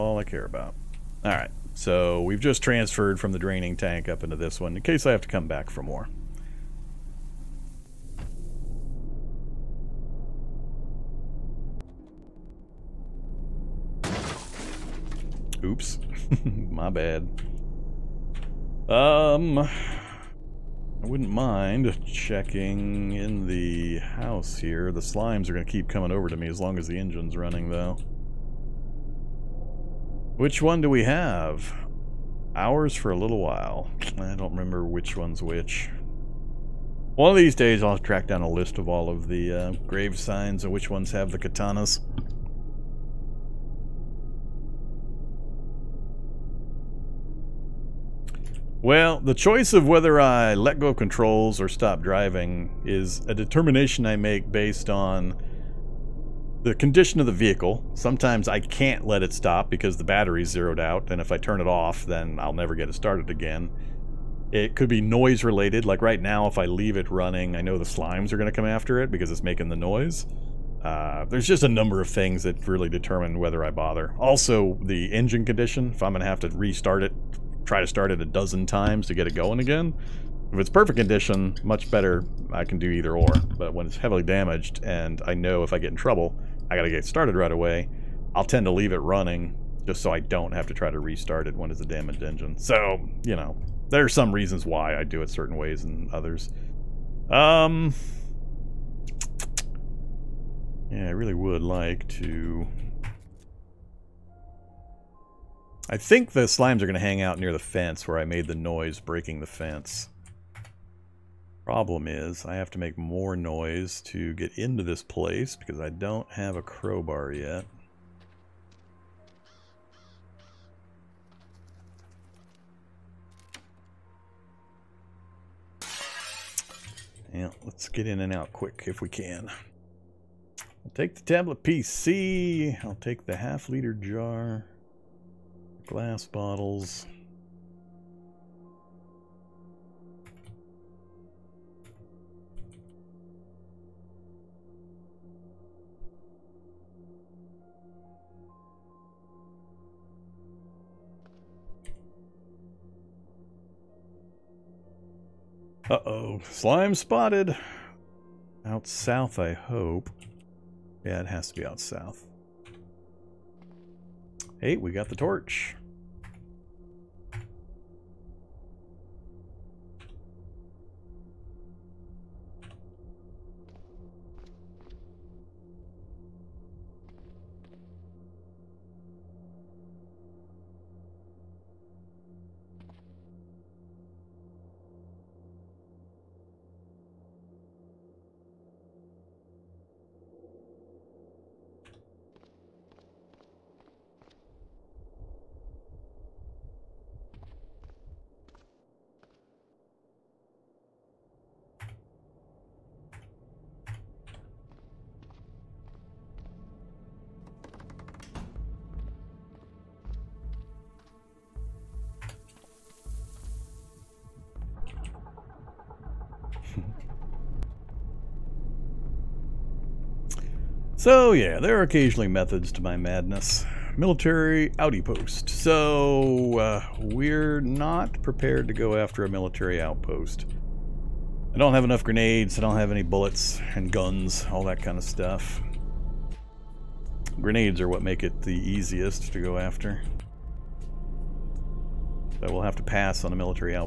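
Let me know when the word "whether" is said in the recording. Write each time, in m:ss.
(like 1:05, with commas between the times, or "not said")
0:49, 1:13.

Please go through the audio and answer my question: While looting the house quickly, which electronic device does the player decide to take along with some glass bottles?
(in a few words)
tablet PC.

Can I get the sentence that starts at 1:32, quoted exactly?
So, you know, there are some reasons why I do it certain ways and others.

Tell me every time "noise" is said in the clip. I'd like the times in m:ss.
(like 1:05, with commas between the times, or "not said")
1:05, 1:09, 1:48, 1:53.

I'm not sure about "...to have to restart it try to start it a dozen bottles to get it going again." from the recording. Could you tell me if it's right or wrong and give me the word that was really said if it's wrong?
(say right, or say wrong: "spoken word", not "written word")
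wrong: "times", not "bottles".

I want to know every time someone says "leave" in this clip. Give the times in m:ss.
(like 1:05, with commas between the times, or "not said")
1:06, 1:28.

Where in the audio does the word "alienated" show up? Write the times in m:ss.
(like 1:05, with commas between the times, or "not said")
not said.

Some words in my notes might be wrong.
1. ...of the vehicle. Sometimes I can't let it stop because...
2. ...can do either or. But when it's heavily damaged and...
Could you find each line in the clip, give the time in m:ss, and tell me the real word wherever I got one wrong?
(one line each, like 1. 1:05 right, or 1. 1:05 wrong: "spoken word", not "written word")
1. 0:57 right
2. 1:22 right.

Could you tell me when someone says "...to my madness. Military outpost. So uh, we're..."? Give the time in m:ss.
3:42.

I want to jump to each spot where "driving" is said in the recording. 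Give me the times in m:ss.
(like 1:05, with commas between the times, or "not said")
0:52.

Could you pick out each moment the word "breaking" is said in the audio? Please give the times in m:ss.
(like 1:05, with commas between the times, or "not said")
1:48.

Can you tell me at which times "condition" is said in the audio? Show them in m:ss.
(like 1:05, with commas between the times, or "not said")
0:56, 1:15, 1:20.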